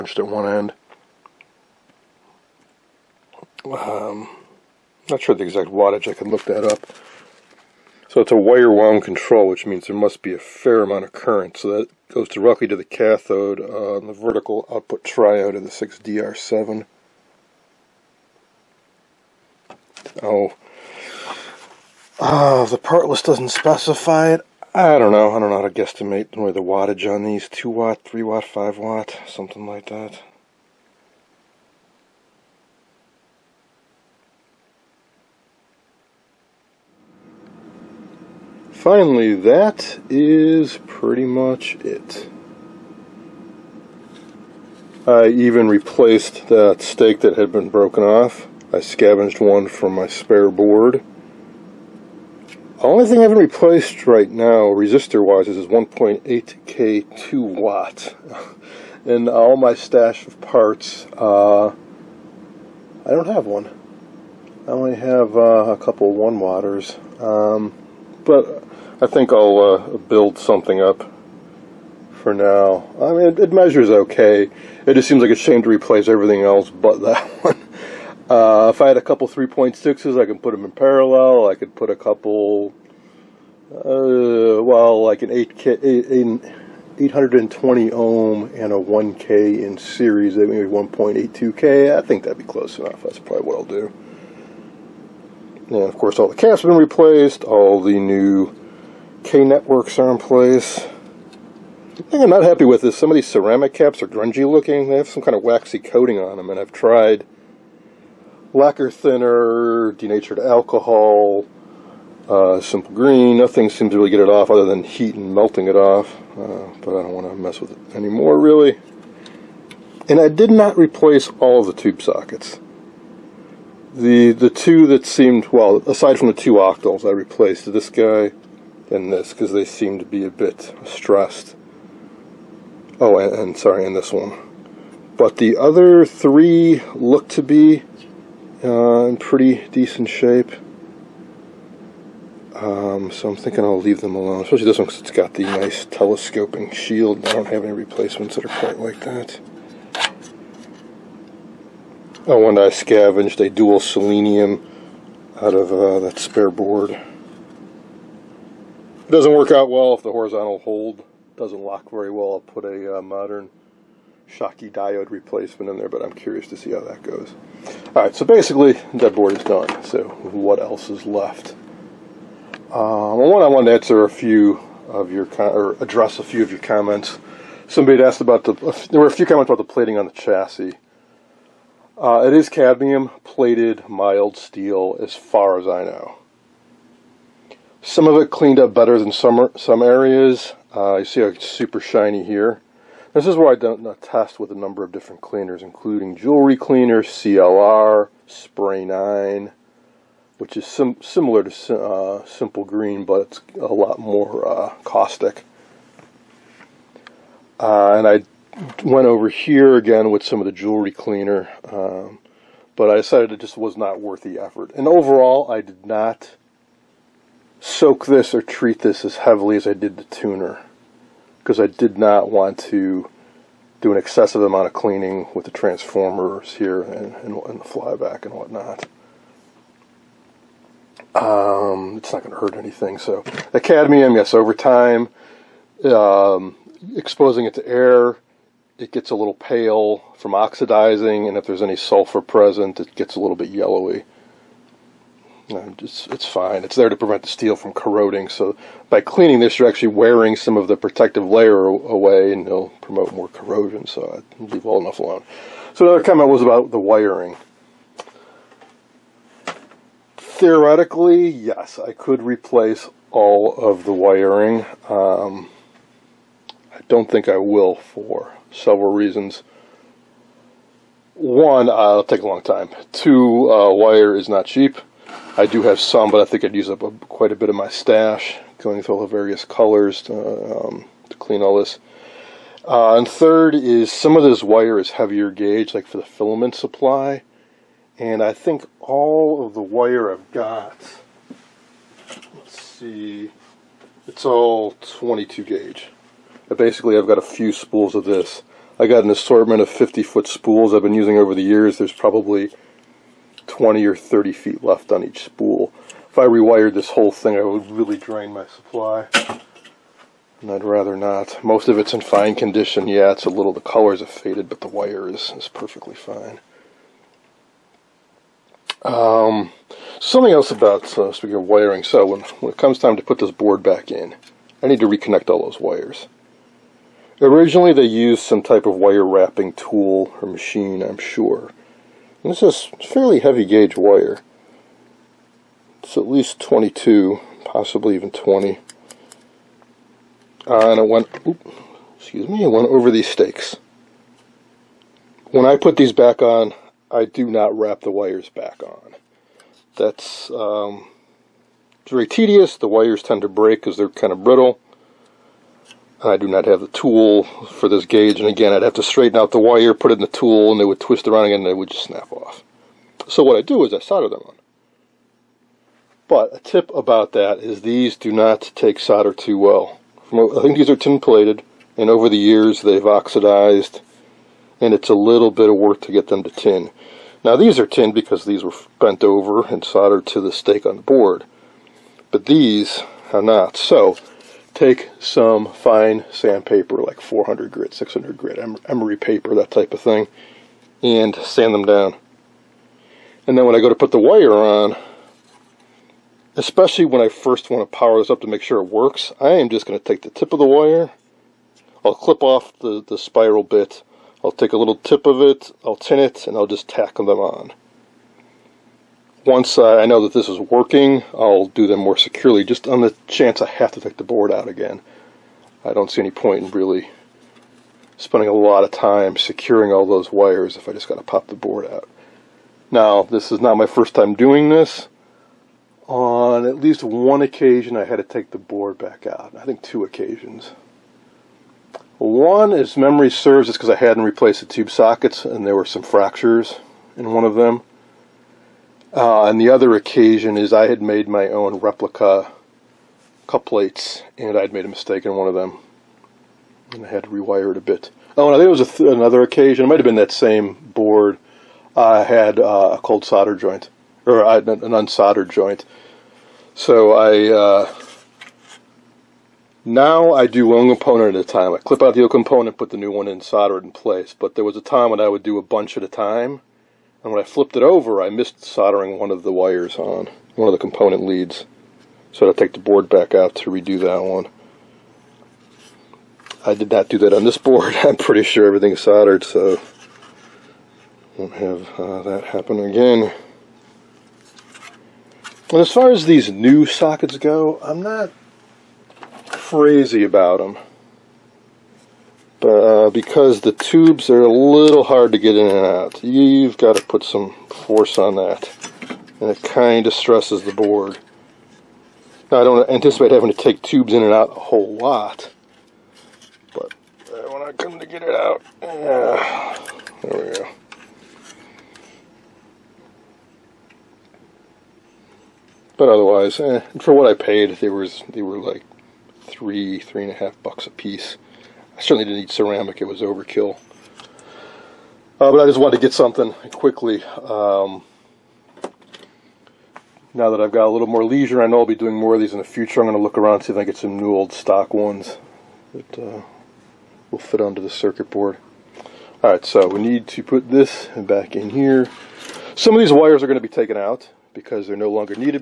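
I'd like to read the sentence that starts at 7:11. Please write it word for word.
One, is memory serves, is because I hadn't replaced the tube sockets and there were some fractures in one of them.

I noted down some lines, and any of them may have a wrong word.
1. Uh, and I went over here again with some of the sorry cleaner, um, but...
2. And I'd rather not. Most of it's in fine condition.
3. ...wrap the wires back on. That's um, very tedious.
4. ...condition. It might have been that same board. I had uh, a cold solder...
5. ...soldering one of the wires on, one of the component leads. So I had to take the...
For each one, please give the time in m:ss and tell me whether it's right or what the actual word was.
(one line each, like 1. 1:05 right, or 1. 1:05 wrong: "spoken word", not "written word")
1. 3:27 wrong: "jewelry", not "sorry"
2. 5:10 right
3. 5:47 right
4. 7:29 wrong: "occasion", not "condition"
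5. 7:48 right.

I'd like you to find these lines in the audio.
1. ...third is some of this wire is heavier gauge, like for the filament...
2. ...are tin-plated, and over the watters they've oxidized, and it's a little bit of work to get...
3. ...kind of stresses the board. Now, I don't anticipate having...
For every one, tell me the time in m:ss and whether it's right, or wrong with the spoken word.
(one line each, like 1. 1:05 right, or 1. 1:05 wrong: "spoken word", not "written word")
1. 4:43 right
2. 6:10 wrong: "years", not "watters"
3. 8:19 right.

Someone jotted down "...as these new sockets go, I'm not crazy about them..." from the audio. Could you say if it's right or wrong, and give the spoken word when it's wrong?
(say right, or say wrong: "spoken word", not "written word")
right.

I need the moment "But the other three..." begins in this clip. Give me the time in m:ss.
2:15.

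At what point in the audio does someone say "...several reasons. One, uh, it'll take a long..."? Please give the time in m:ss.
4:28.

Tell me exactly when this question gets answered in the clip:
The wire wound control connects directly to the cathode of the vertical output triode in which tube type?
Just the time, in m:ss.
0:15.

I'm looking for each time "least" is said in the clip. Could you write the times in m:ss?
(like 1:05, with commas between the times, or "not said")
5:36, 7:06.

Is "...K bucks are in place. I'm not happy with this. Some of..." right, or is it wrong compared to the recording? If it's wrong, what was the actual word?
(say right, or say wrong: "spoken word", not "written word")
wrong: "networks", not "bucks".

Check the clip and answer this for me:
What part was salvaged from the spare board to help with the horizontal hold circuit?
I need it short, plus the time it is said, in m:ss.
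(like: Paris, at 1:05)
dual selenium, at 2:33.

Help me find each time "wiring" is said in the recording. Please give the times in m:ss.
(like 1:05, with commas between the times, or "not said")
4:16, 4:23, 5:21.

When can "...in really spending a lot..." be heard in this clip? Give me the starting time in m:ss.
6:56.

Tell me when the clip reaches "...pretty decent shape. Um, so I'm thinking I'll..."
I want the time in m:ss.
2:19.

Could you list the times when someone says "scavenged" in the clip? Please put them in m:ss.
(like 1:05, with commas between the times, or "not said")
0:48, 2:32.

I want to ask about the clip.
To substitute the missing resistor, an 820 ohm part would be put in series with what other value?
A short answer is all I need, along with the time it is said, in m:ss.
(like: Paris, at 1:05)
1K, at 1:28.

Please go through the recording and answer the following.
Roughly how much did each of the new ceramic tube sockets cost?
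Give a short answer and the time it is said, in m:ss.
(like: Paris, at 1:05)
3 and a half dollars, at 8:39.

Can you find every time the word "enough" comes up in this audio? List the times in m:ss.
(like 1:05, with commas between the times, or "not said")
1:32, 4:14.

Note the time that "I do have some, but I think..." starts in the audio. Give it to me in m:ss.
4:35.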